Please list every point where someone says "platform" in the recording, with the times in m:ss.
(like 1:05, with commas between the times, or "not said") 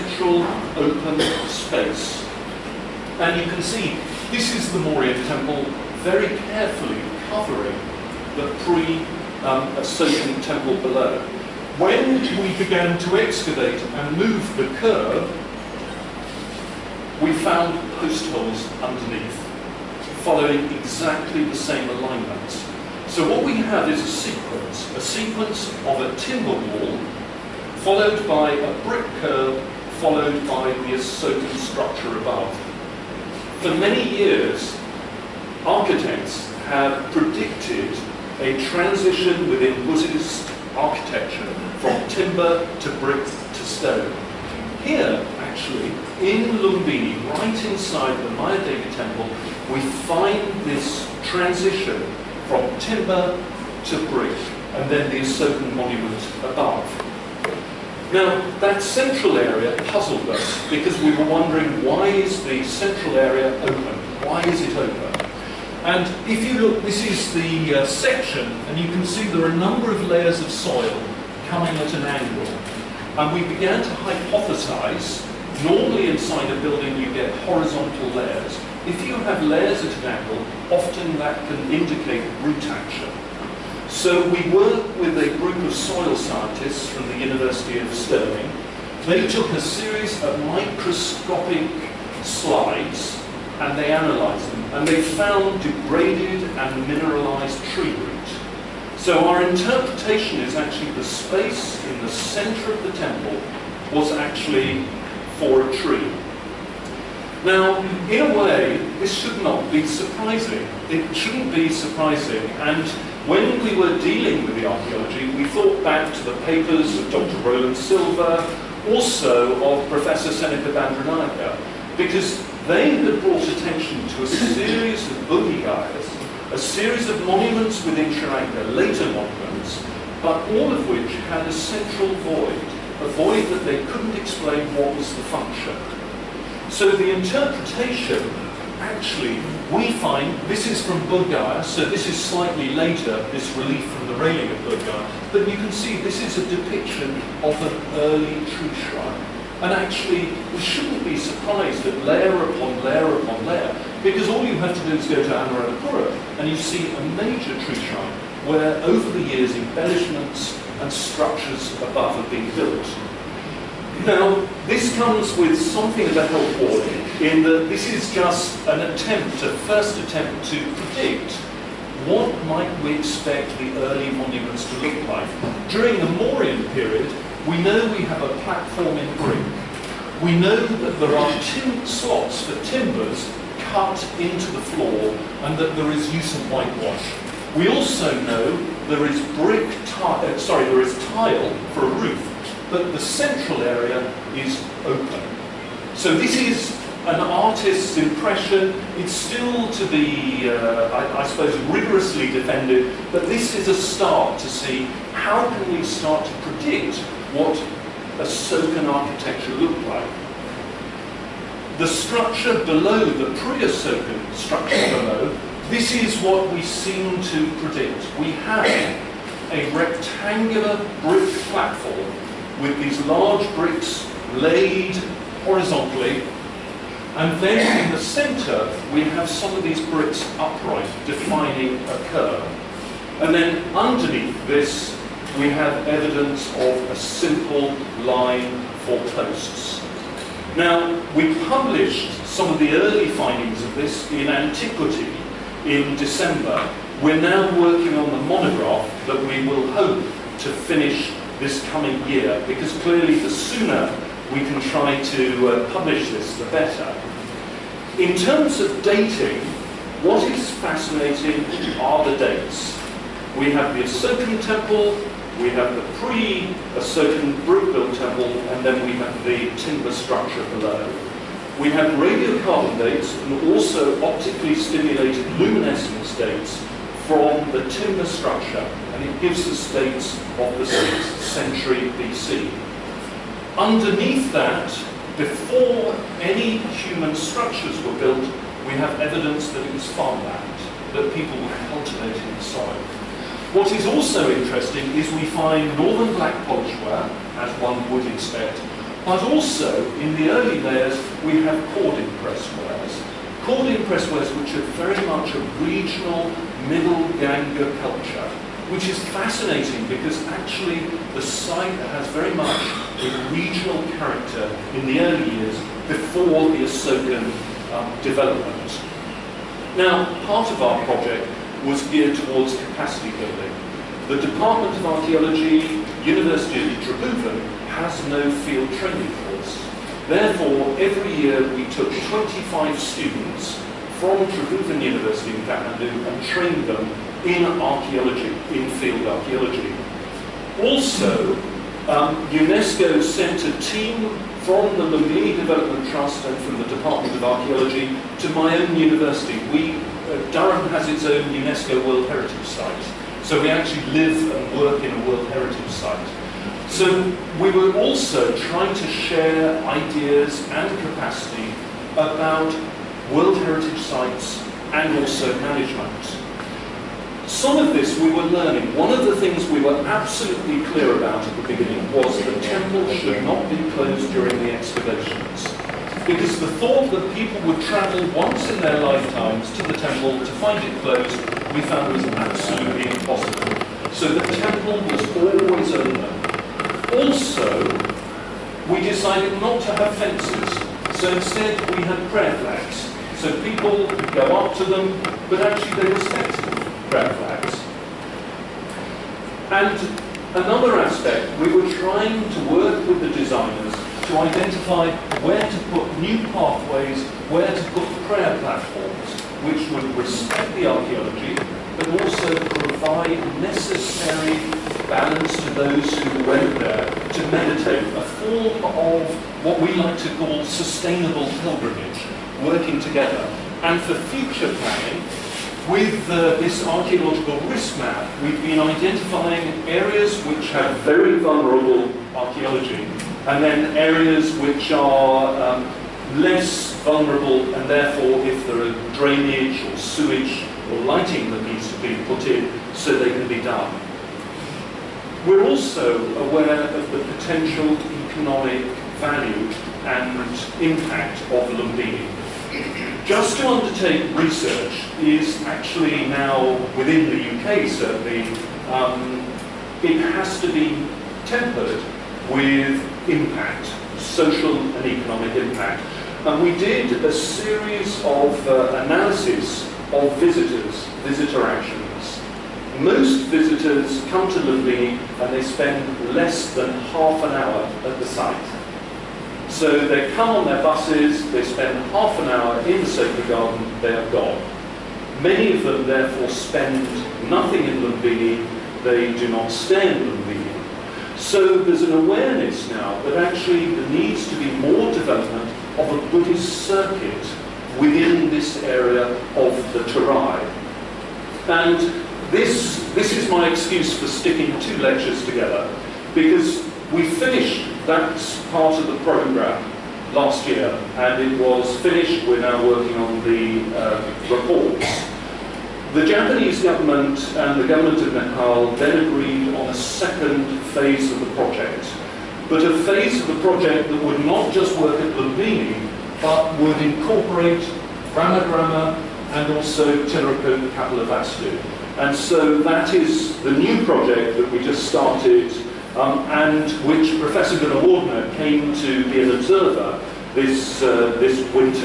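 2:58, 3:41, 6:48.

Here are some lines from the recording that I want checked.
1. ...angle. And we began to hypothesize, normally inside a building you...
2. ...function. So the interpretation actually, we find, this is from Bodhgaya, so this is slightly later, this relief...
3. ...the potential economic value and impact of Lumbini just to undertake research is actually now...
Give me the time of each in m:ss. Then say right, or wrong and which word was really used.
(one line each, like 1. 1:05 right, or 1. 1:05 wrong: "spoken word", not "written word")
1. 1:12 right
2. 2:15 right
3. 7:26 right.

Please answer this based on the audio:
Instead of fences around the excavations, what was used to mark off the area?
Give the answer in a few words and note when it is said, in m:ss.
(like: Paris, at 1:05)
Prayer flags, at 6:32.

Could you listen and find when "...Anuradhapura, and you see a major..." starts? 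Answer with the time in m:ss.
2:35.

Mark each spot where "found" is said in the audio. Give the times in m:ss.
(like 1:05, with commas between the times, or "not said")
0:17, 1:35, 6:21.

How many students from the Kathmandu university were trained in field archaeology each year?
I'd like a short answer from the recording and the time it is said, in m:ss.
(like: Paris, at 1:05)
25, at 5:32.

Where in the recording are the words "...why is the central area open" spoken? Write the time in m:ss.
1:01.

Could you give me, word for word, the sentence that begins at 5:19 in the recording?
Now, part of our project was geared towards capacity building.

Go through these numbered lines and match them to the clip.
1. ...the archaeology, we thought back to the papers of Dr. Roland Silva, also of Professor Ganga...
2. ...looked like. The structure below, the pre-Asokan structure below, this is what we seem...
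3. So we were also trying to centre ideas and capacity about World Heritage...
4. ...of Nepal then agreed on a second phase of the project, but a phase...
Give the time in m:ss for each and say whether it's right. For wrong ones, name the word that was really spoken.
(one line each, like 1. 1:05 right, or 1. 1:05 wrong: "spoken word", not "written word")
1. 1:54 wrong: "Senake", not "Ganga"
2. 3:29 right
3. 5:56 wrong: "share", not "centre"
4. 8:38 right.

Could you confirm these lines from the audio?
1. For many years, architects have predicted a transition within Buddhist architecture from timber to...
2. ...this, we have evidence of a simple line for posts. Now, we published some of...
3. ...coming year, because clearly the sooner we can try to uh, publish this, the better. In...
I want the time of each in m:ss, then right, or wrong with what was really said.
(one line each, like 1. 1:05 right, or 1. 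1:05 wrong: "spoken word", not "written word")
1. 0:33 right
2. 3:54 right
3. 4:11 right.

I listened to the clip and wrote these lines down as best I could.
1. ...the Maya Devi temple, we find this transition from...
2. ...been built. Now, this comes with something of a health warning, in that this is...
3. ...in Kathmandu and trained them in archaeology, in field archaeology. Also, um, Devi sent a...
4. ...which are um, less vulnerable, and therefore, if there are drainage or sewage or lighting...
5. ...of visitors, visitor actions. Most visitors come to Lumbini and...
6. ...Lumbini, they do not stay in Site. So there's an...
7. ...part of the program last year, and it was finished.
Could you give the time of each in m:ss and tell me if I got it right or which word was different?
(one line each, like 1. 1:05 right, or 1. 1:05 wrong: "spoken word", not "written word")
1. 0:48 right
2. 2:42 right
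3. 5:35 wrong: "UNESCO", not "Devi"
4. 7:14 right
5. 7:49 right
6. 8:07 wrong: "Lumbini", not "Site"
7. 8:28 right.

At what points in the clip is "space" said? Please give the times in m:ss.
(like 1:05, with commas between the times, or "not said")
0:01, 1:41.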